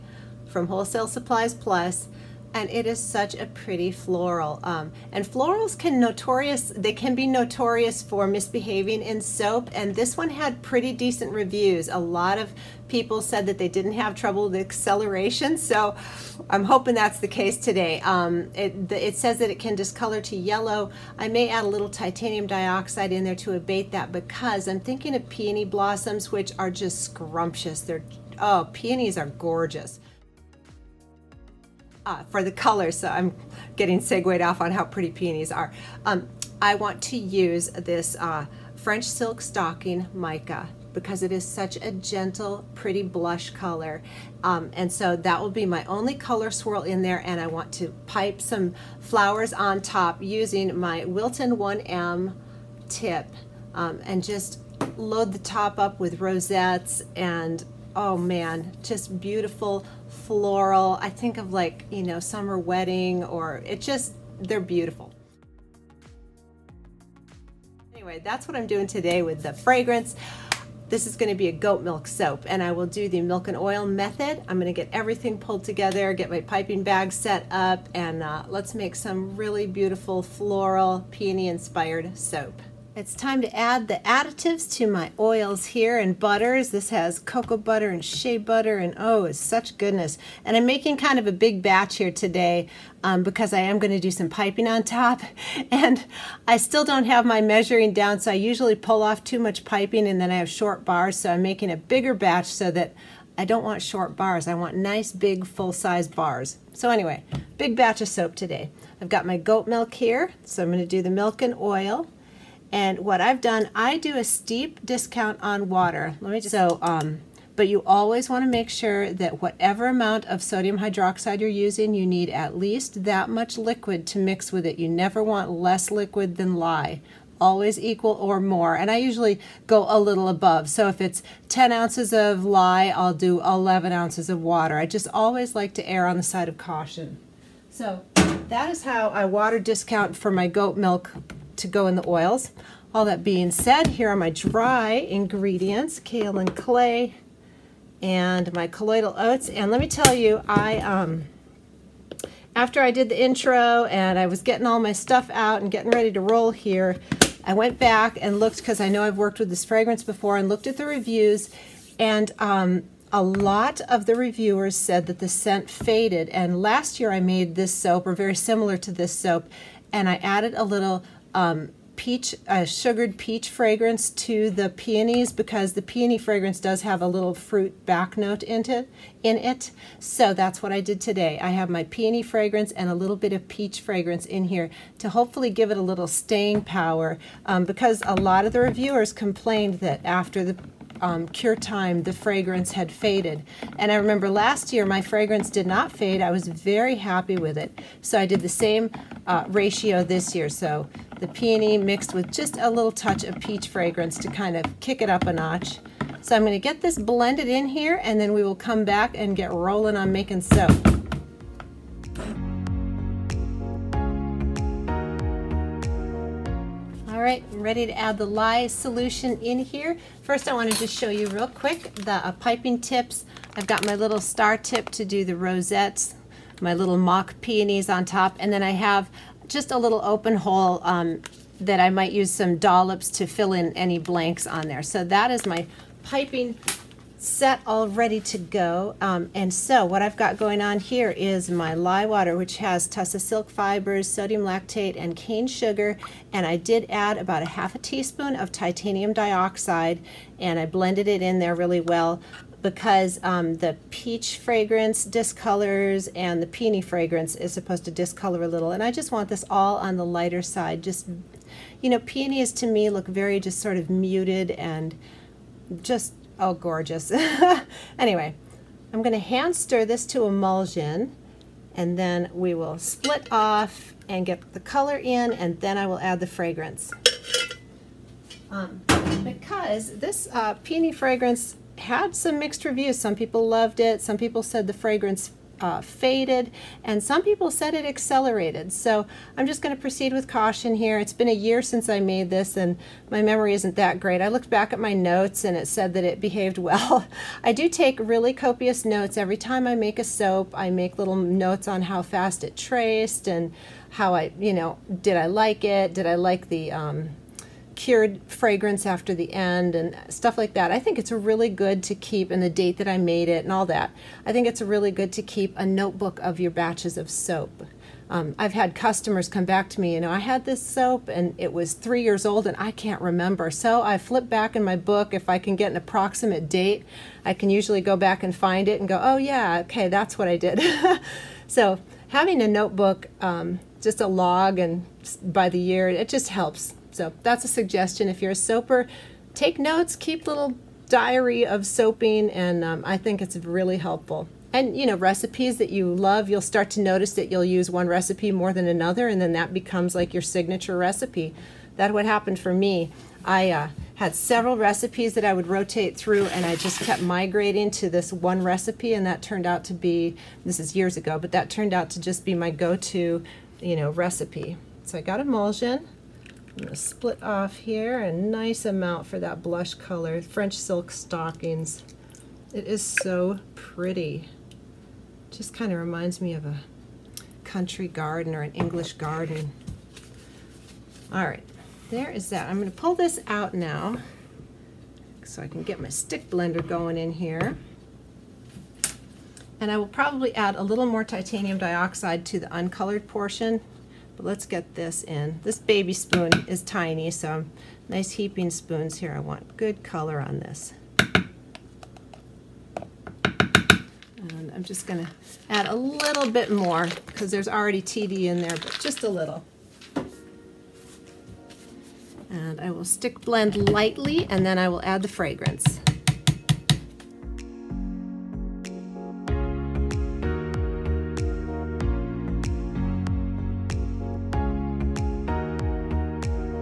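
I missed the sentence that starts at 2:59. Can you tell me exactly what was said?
So that's what I did today.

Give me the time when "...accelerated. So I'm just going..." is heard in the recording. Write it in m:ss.
4:47.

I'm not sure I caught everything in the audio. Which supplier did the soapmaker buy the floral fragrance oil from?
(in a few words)
Wholesale Supplies Plus.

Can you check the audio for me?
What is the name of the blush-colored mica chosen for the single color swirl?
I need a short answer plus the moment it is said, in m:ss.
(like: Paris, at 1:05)
French Silk Stocking, at 0:38.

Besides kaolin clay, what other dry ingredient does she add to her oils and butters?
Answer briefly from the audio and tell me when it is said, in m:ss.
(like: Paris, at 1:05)
colloidal oats, at 2:28.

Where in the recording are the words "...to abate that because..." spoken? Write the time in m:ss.
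0:23.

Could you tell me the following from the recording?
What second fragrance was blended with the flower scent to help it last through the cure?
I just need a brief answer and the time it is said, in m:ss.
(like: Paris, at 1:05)
sugared peach, at 2:52.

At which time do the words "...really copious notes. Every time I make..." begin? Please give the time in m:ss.
4:57.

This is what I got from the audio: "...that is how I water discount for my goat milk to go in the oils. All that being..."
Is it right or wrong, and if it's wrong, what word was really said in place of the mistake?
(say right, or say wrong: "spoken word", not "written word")
right.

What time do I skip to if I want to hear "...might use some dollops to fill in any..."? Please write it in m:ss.
3:51.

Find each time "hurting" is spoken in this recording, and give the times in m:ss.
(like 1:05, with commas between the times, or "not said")
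not said.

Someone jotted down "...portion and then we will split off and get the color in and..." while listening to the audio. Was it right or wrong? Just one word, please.
wrong.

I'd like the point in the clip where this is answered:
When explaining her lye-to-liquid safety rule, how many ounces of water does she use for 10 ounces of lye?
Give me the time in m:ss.
2:13.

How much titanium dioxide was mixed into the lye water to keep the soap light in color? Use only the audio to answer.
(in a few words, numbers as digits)
half a teaspoon.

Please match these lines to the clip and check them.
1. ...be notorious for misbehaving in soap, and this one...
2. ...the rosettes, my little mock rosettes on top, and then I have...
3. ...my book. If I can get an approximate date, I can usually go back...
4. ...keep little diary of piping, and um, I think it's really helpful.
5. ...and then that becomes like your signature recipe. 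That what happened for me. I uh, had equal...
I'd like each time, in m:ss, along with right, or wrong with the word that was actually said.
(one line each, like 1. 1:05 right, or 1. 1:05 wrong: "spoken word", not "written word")
1. 0:07 right
2. 3:45 wrong: "peonies", not "rosettes"
3. 5:24 right
4. 5:39 wrong: "soaping", not "piping"
5. 5:49 wrong: "several", not "equal".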